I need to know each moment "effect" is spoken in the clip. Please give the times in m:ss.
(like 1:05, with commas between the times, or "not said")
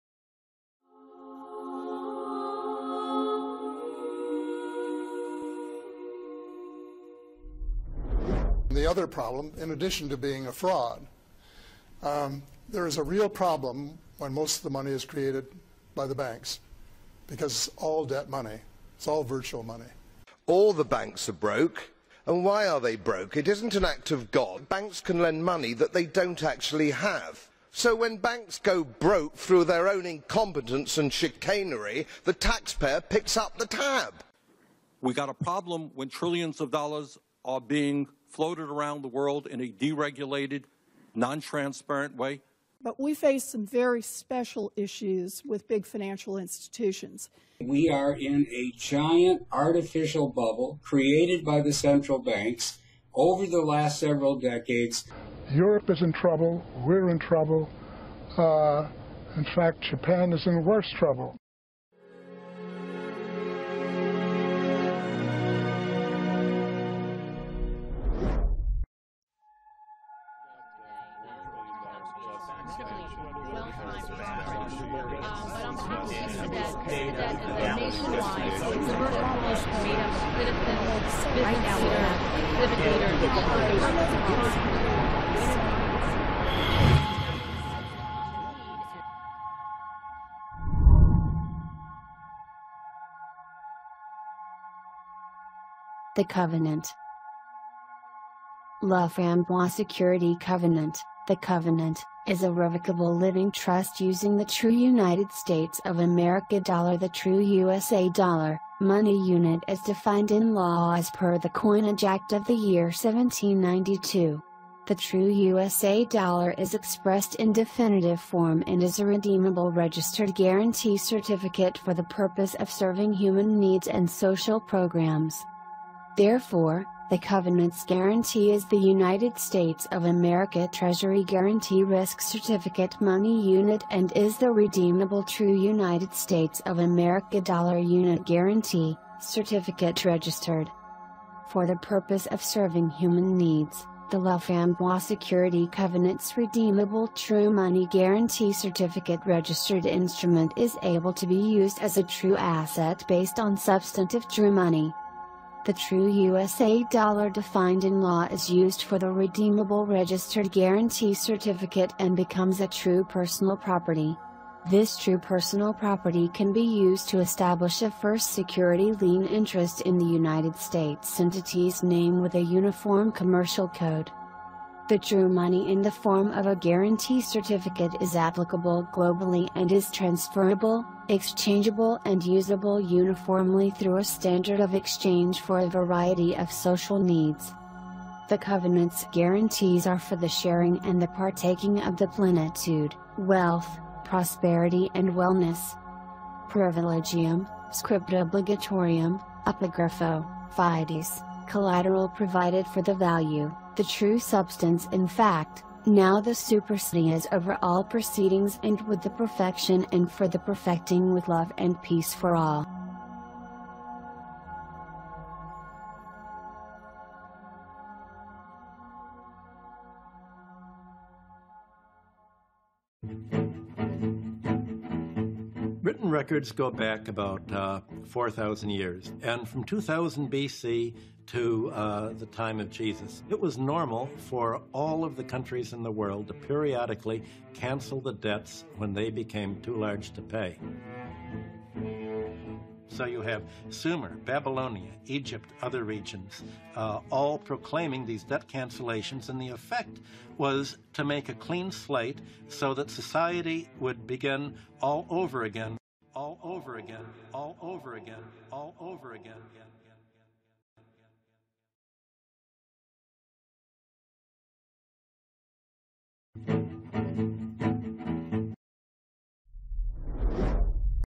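4:09.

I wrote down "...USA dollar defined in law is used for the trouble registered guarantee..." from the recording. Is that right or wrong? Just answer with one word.
wrong.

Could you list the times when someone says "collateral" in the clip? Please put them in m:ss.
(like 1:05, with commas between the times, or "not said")
3:21.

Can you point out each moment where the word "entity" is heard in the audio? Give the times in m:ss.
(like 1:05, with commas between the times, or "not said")
2:51.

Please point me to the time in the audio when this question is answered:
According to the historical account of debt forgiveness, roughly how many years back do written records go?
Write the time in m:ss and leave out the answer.
3:48.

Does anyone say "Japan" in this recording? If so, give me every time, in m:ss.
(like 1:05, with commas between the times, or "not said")
0:59.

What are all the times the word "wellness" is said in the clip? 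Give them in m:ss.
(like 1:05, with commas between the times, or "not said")
3:15.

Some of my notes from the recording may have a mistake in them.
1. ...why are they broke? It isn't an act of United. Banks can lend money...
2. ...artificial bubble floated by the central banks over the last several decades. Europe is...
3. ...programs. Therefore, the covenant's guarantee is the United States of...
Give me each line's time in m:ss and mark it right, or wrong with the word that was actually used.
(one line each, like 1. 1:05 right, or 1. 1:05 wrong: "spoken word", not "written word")
1. 0:22 wrong: "God", not "United"
2. 0:49 wrong: "created", not "floated"
3. 2:04 right.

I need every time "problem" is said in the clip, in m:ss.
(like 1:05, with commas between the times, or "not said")
0:09, 0:13, 0:35.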